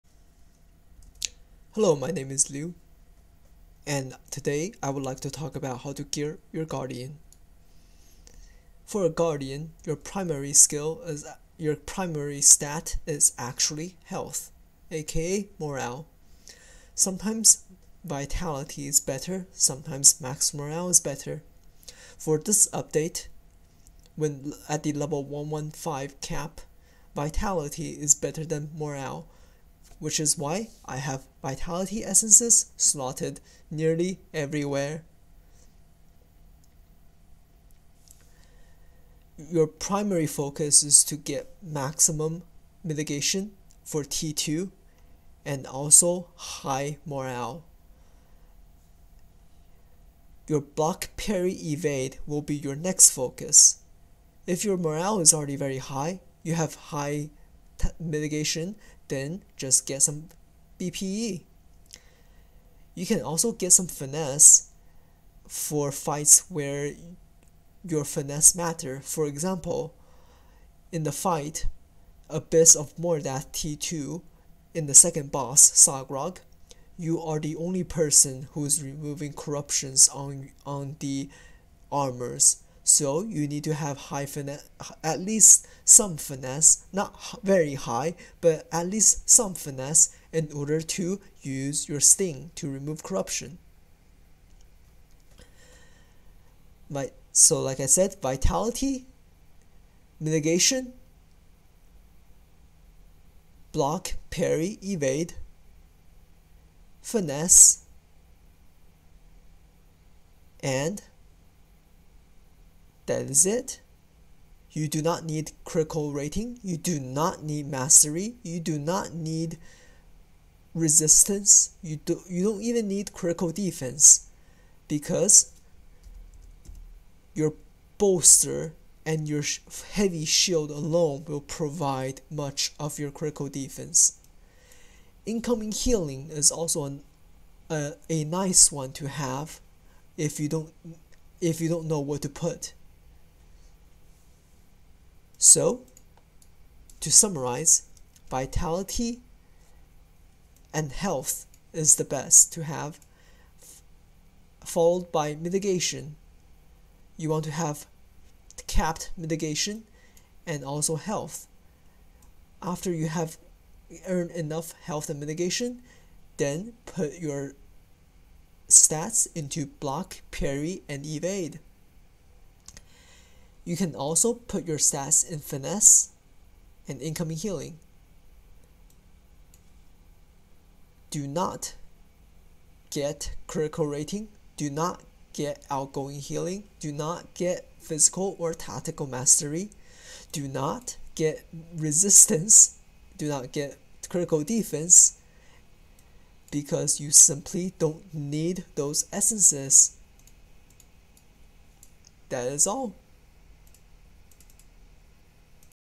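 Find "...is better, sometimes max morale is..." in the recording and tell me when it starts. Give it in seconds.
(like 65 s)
18 s.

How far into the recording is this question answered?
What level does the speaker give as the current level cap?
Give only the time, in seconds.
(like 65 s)
25 s.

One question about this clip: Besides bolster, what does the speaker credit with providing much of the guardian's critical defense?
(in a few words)
heavy shield.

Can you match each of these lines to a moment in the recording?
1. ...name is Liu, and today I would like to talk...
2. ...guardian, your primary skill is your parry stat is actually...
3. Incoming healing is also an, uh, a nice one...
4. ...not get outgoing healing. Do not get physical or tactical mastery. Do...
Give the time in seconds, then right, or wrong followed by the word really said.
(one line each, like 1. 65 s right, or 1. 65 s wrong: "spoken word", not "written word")
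1. 2 s right
2. 9 s wrong: "primary", not "parry"
3. 135 s right
4. 184 s right.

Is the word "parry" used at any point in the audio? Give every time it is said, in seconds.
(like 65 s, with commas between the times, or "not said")
51 s, 104 s, 170 s.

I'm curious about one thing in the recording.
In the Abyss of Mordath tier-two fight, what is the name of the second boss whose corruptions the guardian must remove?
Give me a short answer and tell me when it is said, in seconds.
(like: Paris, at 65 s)
Sagrog, at 75 s.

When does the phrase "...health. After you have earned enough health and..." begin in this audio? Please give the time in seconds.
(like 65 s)
160 s.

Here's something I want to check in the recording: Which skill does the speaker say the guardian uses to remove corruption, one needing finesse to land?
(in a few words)
sting.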